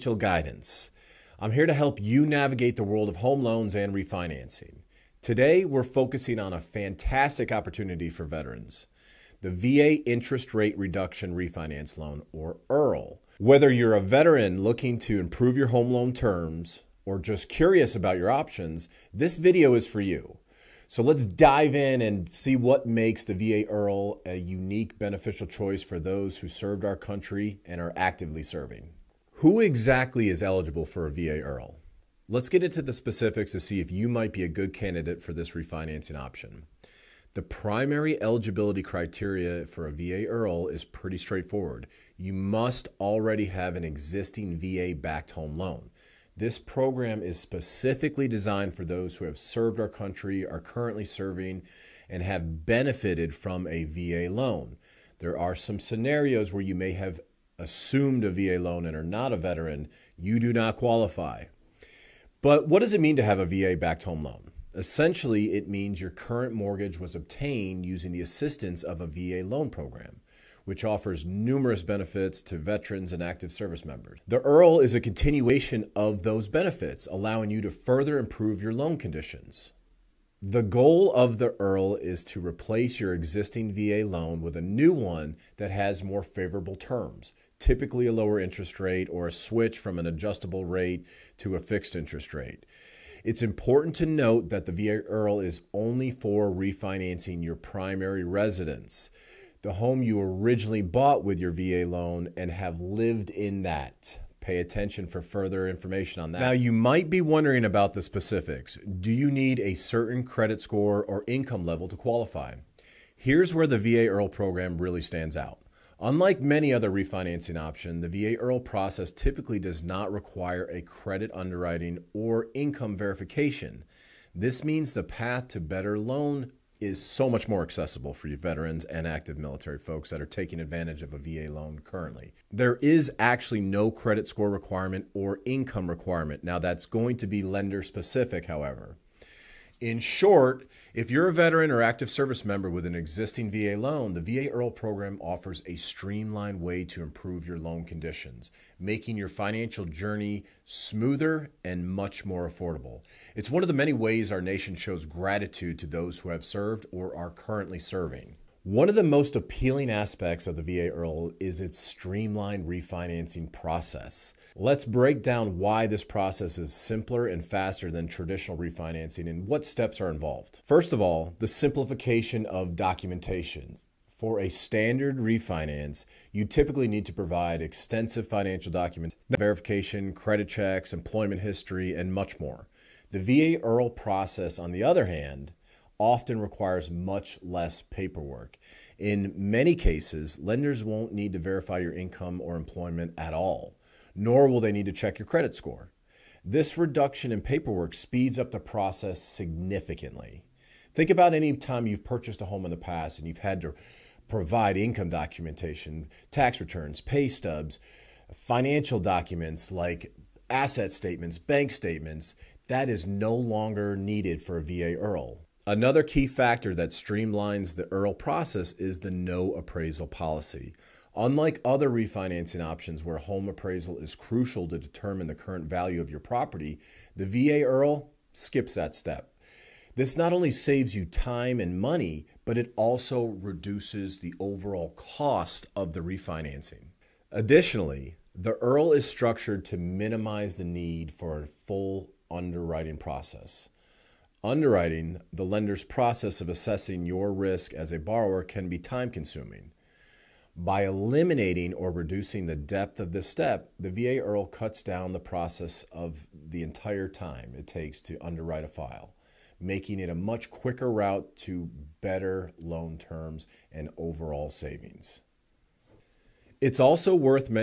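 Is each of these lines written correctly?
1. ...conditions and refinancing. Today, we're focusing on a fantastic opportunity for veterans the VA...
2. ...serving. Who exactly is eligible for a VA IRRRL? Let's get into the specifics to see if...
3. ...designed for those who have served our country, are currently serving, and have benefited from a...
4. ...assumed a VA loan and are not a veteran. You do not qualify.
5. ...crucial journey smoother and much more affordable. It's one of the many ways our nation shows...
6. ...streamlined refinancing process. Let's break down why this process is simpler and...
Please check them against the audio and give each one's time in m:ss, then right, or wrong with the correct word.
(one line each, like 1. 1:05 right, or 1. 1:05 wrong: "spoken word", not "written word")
1. 0:03 wrong: "loans", not "conditions"
2. 0:28 right
3. 0:48 right
4. 0:57 right
5. 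2:29 wrong: "financial", not "crucial"
6. 2:41 right.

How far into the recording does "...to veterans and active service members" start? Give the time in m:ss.
1:12.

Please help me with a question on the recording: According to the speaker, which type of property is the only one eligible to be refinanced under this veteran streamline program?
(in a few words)
primary residence.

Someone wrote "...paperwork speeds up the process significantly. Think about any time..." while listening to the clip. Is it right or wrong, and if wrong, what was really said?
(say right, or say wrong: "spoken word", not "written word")
right.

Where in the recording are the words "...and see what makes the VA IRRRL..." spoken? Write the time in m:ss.
0:22.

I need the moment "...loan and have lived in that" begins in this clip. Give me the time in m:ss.
1:41.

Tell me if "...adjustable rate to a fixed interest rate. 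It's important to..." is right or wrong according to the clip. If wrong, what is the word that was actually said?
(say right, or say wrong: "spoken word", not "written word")
right.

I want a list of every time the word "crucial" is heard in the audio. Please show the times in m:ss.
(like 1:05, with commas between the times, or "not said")
3:44.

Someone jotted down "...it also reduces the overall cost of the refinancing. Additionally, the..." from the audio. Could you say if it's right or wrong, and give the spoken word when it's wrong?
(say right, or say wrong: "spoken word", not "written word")
right.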